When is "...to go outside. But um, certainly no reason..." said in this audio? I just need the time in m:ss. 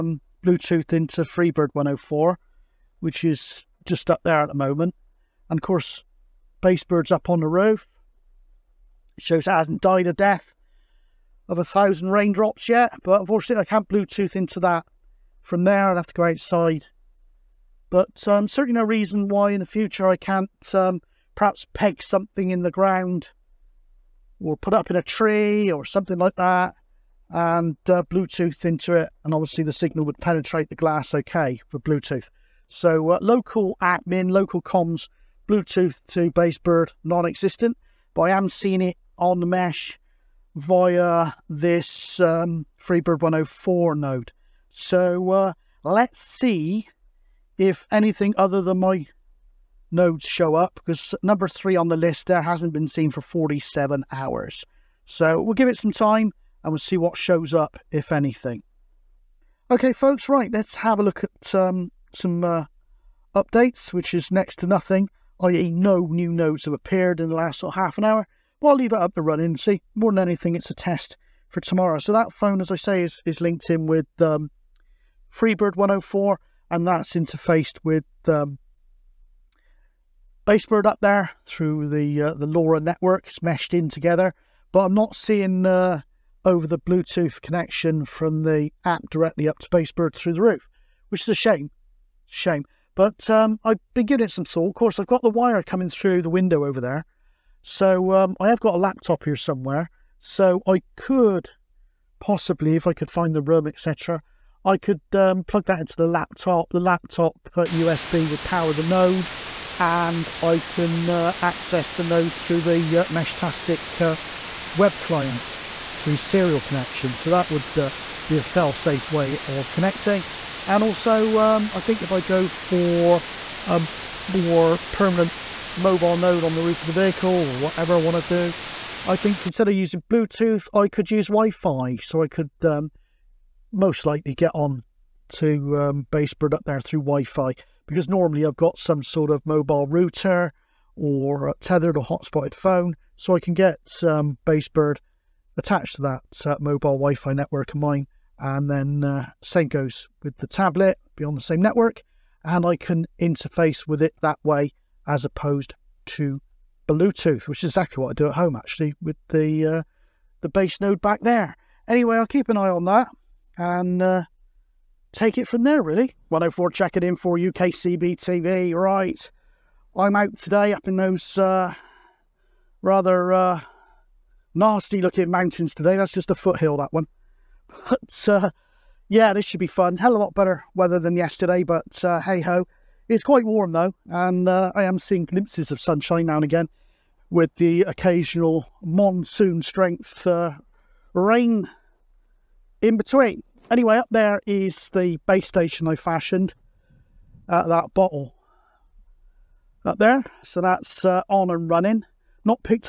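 0:16.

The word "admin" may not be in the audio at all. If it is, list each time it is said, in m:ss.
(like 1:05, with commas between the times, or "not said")
0:33.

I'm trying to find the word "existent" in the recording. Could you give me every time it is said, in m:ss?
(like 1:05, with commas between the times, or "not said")
0:37.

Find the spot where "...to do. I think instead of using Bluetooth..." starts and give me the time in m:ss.
2:08.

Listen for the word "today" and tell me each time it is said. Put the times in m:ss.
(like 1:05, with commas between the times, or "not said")
2:50, 2:55.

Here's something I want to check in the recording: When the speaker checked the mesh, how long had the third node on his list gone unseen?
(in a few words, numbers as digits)
47 hours.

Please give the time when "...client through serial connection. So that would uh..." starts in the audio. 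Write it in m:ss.
1:54.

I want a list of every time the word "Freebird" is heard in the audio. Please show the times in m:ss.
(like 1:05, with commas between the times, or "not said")
0:01, 0:42, 1:15.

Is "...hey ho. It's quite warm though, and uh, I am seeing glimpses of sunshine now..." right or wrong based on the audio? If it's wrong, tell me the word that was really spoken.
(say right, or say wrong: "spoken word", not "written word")
right.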